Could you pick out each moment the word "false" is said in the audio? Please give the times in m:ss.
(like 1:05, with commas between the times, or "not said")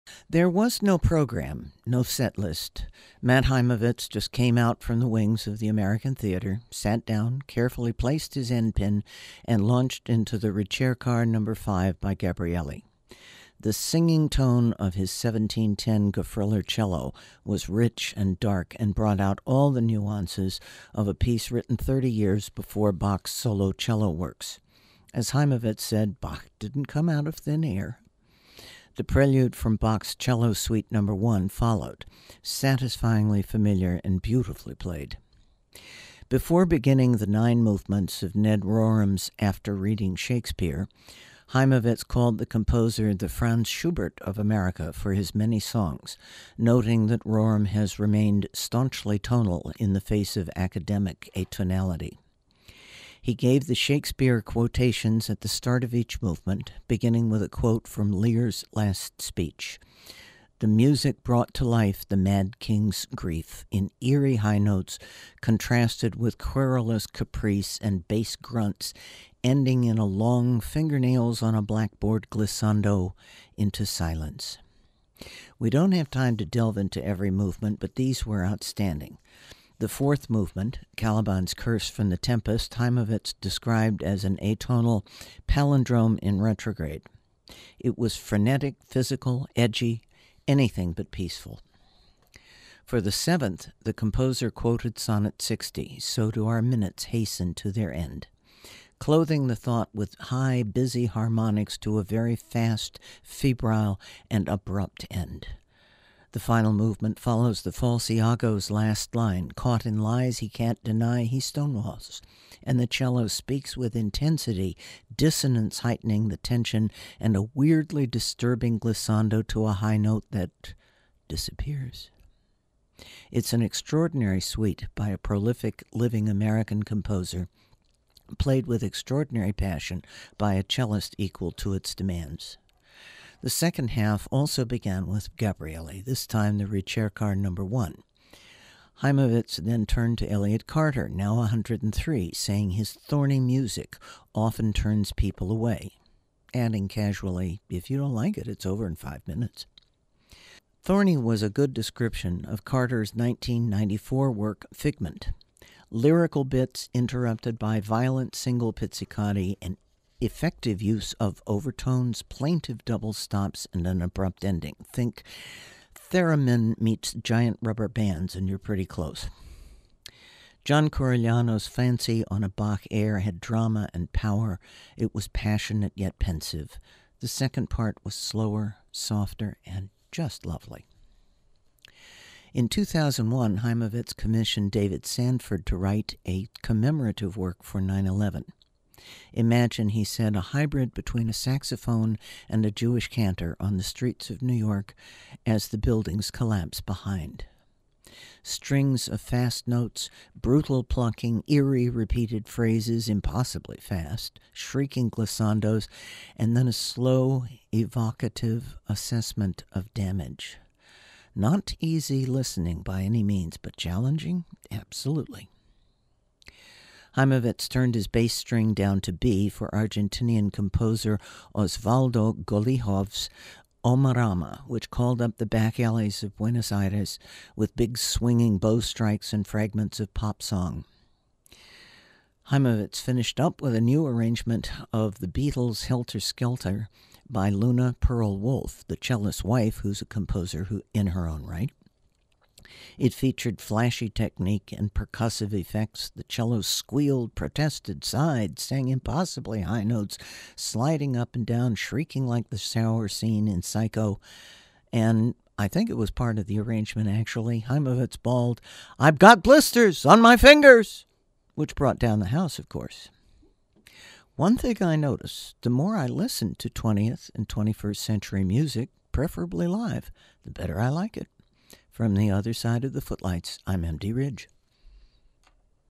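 1:47.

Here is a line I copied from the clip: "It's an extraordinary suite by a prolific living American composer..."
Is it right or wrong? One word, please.
right.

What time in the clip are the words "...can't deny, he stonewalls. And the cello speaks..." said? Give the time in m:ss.
1:50.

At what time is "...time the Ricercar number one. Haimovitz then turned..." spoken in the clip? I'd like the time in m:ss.
2:16.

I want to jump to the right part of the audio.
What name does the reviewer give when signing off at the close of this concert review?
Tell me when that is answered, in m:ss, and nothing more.
4:33.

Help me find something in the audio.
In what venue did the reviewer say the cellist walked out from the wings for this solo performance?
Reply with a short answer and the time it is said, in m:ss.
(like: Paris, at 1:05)
American Theater, at 0:05.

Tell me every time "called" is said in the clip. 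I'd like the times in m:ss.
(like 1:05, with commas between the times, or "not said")
0:42, 3:44.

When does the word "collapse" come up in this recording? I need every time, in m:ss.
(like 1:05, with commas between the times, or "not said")
3:16.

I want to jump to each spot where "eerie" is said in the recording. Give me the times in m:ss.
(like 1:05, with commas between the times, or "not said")
1:04, 3:21.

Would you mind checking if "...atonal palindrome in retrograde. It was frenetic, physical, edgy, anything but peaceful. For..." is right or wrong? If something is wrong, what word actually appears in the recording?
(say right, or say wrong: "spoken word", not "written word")
right.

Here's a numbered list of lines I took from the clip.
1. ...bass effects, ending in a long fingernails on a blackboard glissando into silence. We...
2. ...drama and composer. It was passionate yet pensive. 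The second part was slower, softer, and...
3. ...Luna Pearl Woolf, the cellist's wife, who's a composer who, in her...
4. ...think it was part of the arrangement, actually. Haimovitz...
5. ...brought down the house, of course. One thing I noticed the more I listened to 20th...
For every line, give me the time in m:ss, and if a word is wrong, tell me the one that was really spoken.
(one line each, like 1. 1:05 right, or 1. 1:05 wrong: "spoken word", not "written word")
1. 1:08 wrong: "grunts", not "effects"
2. 2:53 wrong: "power", not "composer"
3. 3:57 right
4. 4:15 right
5. 4:21 right.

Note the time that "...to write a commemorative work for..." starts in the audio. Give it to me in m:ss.
3:05.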